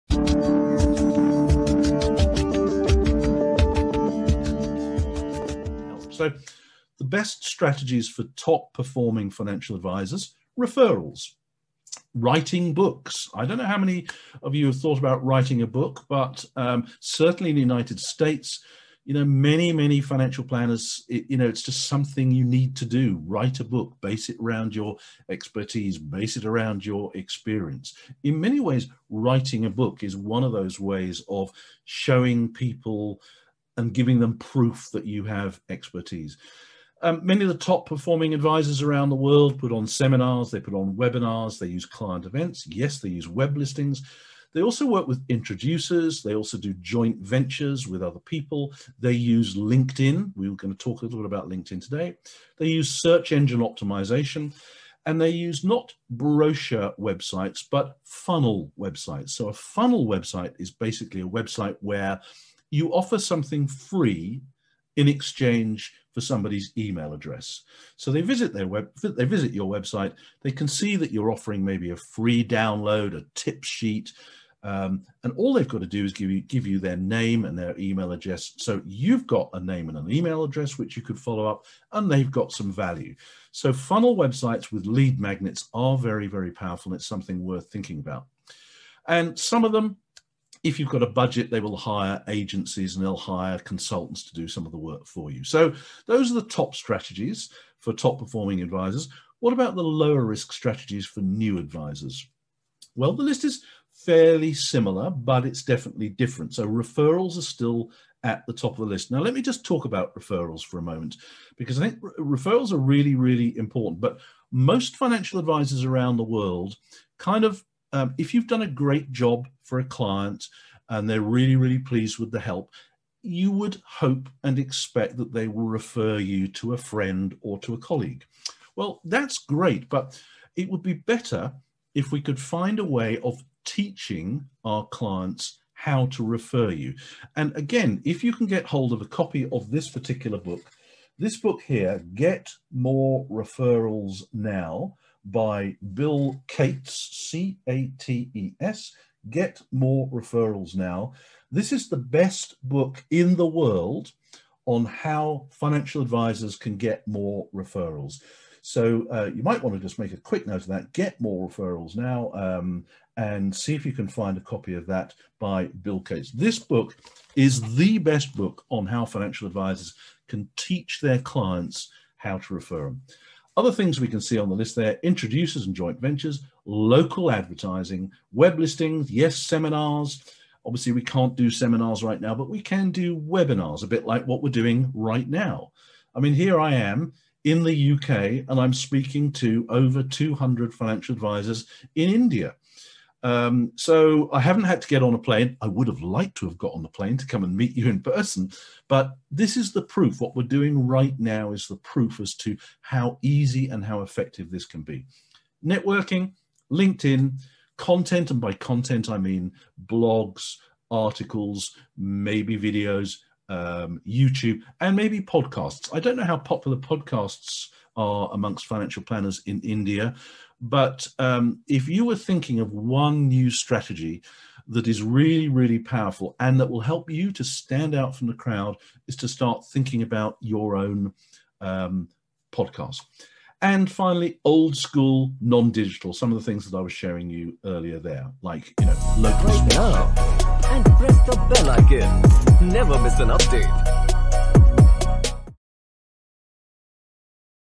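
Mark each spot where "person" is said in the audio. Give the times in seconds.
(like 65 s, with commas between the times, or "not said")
198 s.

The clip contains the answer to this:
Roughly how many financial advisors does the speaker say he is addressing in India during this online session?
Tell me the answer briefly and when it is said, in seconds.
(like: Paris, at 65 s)
Over 200, at 189 s.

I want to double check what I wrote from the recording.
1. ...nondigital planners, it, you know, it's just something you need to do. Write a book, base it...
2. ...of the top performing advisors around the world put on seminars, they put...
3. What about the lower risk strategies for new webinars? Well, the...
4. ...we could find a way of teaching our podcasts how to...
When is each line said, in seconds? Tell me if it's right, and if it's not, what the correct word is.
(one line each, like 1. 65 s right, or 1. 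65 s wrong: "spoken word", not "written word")
1. 19 s wrong: "financial", not "nondigital"
2. 37 s right
3. 99 s wrong: "advisors", not "webinars"
4. 132 s wrong: "clients", not "podcasts".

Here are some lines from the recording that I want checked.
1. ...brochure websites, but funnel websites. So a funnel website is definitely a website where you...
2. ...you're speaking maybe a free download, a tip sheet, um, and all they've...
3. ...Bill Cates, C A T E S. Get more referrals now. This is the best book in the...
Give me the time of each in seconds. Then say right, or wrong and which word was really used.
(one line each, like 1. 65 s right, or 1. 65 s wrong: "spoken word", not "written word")
1. 56 s wrong: "basically", not "definitely"
2. 71 s wrong: "offering", not "speaking"
3. 145 s right.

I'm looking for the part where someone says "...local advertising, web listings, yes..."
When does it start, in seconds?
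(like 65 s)
176 s.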